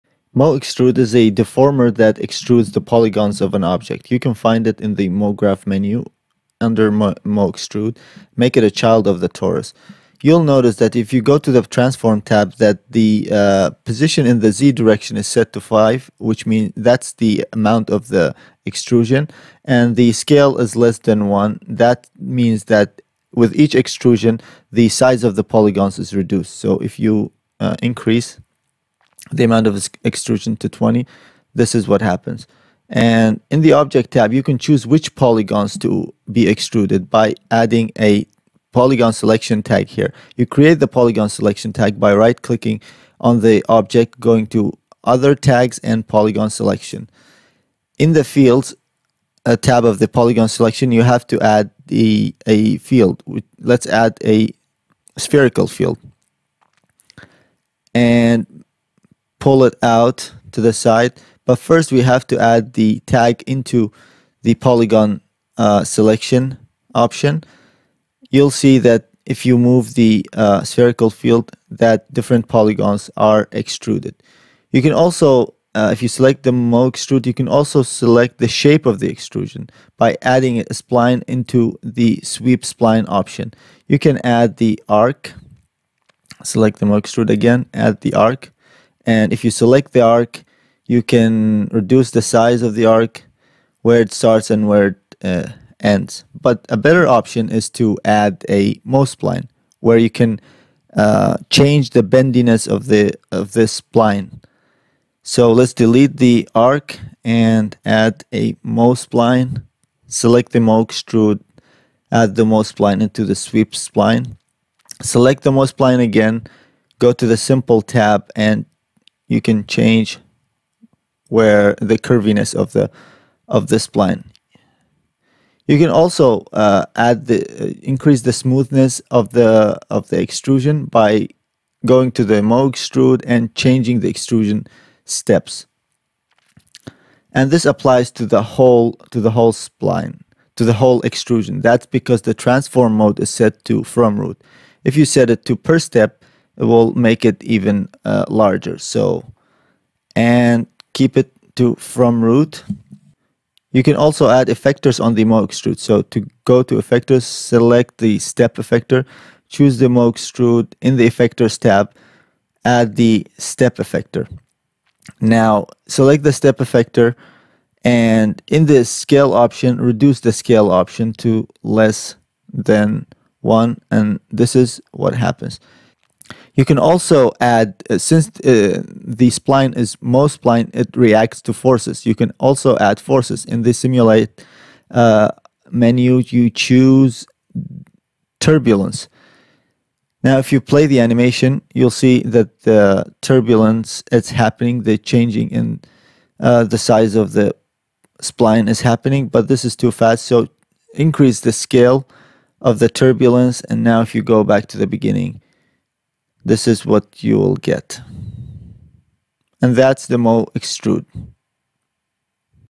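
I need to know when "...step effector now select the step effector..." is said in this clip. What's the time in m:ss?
2:43.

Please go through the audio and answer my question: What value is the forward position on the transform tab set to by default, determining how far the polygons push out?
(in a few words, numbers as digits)
5.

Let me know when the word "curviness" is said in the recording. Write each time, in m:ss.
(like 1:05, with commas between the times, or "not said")
2:01.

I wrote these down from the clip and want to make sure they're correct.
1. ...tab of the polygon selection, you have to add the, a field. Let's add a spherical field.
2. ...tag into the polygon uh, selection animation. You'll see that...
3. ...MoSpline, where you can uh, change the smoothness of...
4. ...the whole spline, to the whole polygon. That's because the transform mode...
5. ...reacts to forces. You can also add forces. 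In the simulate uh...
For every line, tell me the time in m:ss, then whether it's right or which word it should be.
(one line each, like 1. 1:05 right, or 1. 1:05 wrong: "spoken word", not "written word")
1. 0:49 right
2. 1:03 wrong: "option", not "animation"
3. 1:38 wrong: "bendiness", not "smoothness"
4. 2:19 wrong: "extrusion", not "polygon"
5. 3:00 right.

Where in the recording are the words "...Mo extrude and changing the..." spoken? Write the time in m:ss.
2:12.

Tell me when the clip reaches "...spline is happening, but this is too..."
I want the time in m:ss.
3:18.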